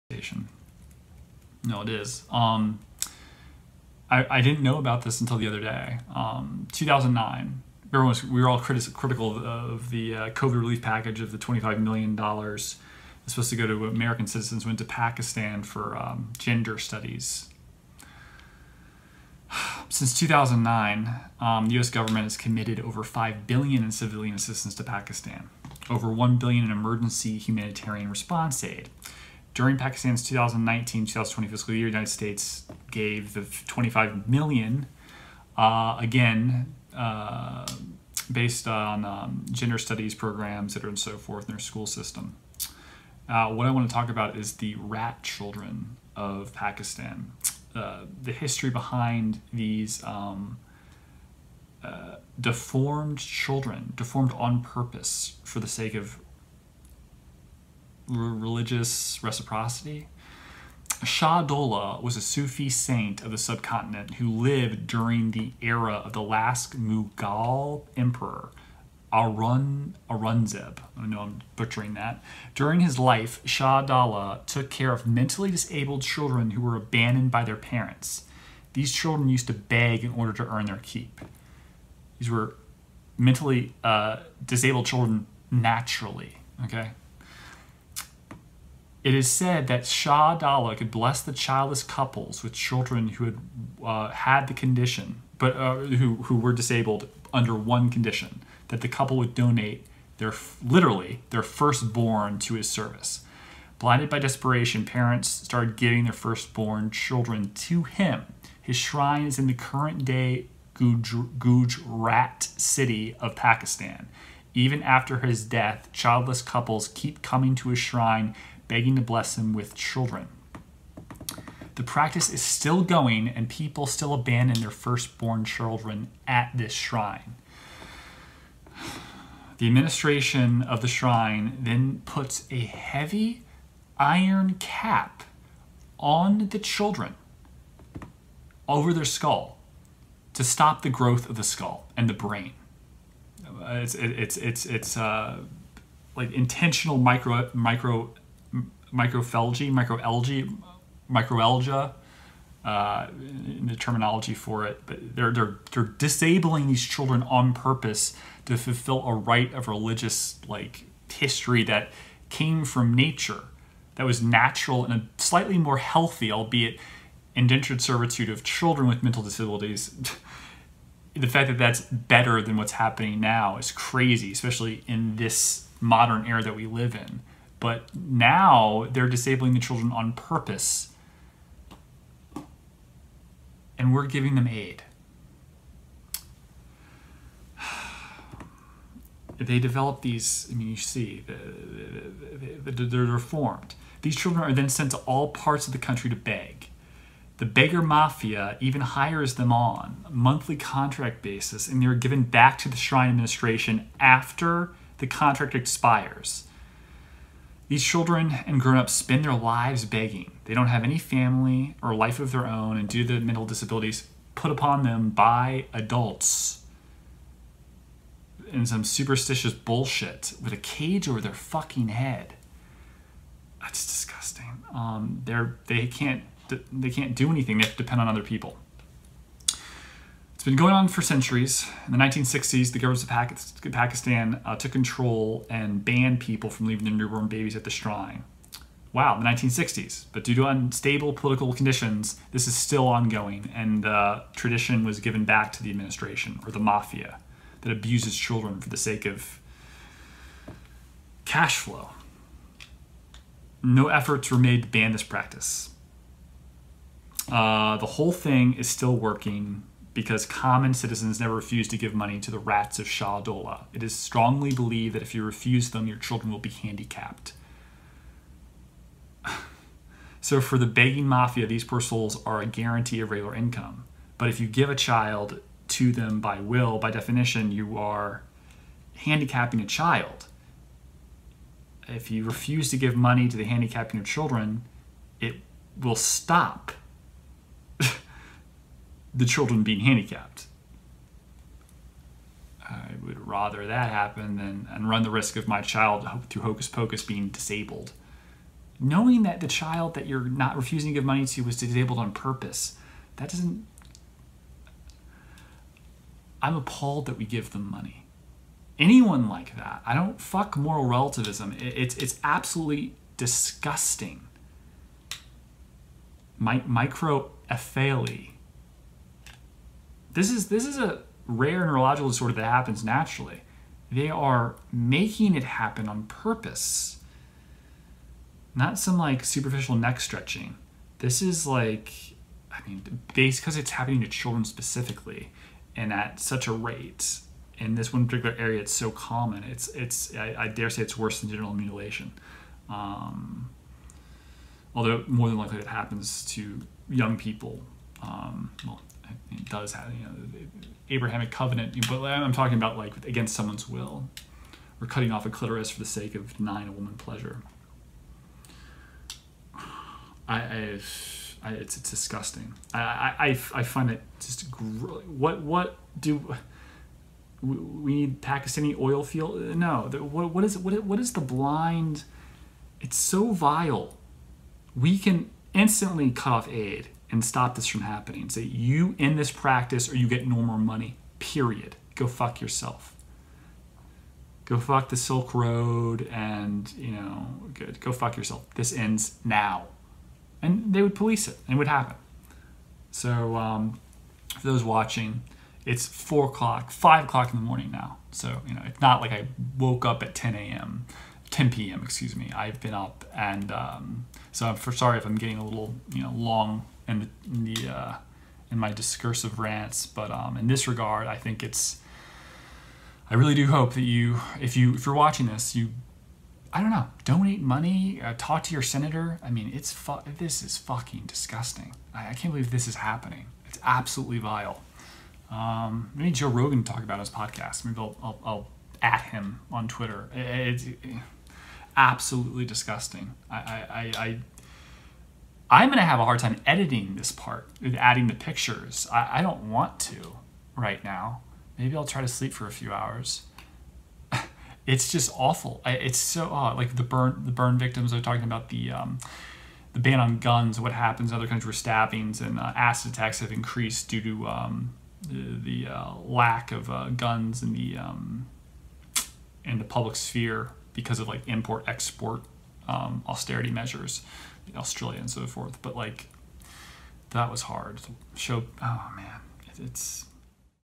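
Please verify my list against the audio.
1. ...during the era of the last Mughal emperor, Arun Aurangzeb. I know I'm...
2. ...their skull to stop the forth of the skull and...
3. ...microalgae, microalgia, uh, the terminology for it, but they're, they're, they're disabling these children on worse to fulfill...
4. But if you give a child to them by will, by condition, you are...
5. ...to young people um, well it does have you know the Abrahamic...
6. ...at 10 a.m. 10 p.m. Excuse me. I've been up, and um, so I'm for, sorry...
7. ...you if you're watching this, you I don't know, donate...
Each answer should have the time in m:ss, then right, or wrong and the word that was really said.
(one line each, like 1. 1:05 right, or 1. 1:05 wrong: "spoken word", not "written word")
1. 1:04 right
2. 2:18 wrong: "growth", not "forth"
3. 2:29 wrong: "purpose", not "worse"
4. 4:34 wrong: "definition", not "condition"
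5. 5:46 right
6. 6:40 right
7. 6:54 right.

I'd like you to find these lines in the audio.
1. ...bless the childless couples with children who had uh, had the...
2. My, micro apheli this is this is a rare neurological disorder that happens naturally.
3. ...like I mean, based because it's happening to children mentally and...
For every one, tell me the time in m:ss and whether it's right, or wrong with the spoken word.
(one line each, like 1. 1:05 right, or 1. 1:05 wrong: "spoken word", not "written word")
1. 1:30 right
2. 5:16 right
3. 5:31 wrong: "specifically", not "mentally".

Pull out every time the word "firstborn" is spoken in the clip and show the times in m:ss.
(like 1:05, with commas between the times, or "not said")
1:41, 1:46, 2:04.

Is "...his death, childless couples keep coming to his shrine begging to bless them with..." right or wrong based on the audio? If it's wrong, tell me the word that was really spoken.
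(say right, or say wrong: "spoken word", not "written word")
right.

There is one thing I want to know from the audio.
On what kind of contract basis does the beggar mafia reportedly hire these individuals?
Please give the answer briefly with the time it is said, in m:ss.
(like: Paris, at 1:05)
monthly, at 3:20.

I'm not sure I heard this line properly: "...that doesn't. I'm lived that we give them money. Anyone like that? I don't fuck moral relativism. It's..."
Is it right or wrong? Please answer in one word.
wrong.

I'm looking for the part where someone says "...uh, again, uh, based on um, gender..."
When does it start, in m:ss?
0:35.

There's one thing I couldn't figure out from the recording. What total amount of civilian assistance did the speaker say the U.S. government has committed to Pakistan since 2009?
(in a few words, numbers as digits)
over 5 billion.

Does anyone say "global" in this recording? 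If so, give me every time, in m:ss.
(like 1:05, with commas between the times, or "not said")
not said.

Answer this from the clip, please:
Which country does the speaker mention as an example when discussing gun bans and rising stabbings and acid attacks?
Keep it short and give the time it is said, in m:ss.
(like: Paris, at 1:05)
Australia, at 7:44.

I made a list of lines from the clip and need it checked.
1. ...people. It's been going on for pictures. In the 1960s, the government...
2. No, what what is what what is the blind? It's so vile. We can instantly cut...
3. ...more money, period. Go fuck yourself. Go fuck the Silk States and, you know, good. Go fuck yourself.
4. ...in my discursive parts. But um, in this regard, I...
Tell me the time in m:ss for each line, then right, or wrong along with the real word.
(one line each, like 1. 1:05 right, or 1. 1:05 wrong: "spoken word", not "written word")
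1. 3:48 wrong: "centuries", not "pictures"
2. 6:09 right
3. 6:20 wrong: "Road", not "States"
4. 6:48 wrong: "rants", not "parts".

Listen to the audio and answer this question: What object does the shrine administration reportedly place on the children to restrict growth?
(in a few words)
heavy iron cap.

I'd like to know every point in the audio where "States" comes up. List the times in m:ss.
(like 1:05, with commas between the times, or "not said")
0:32.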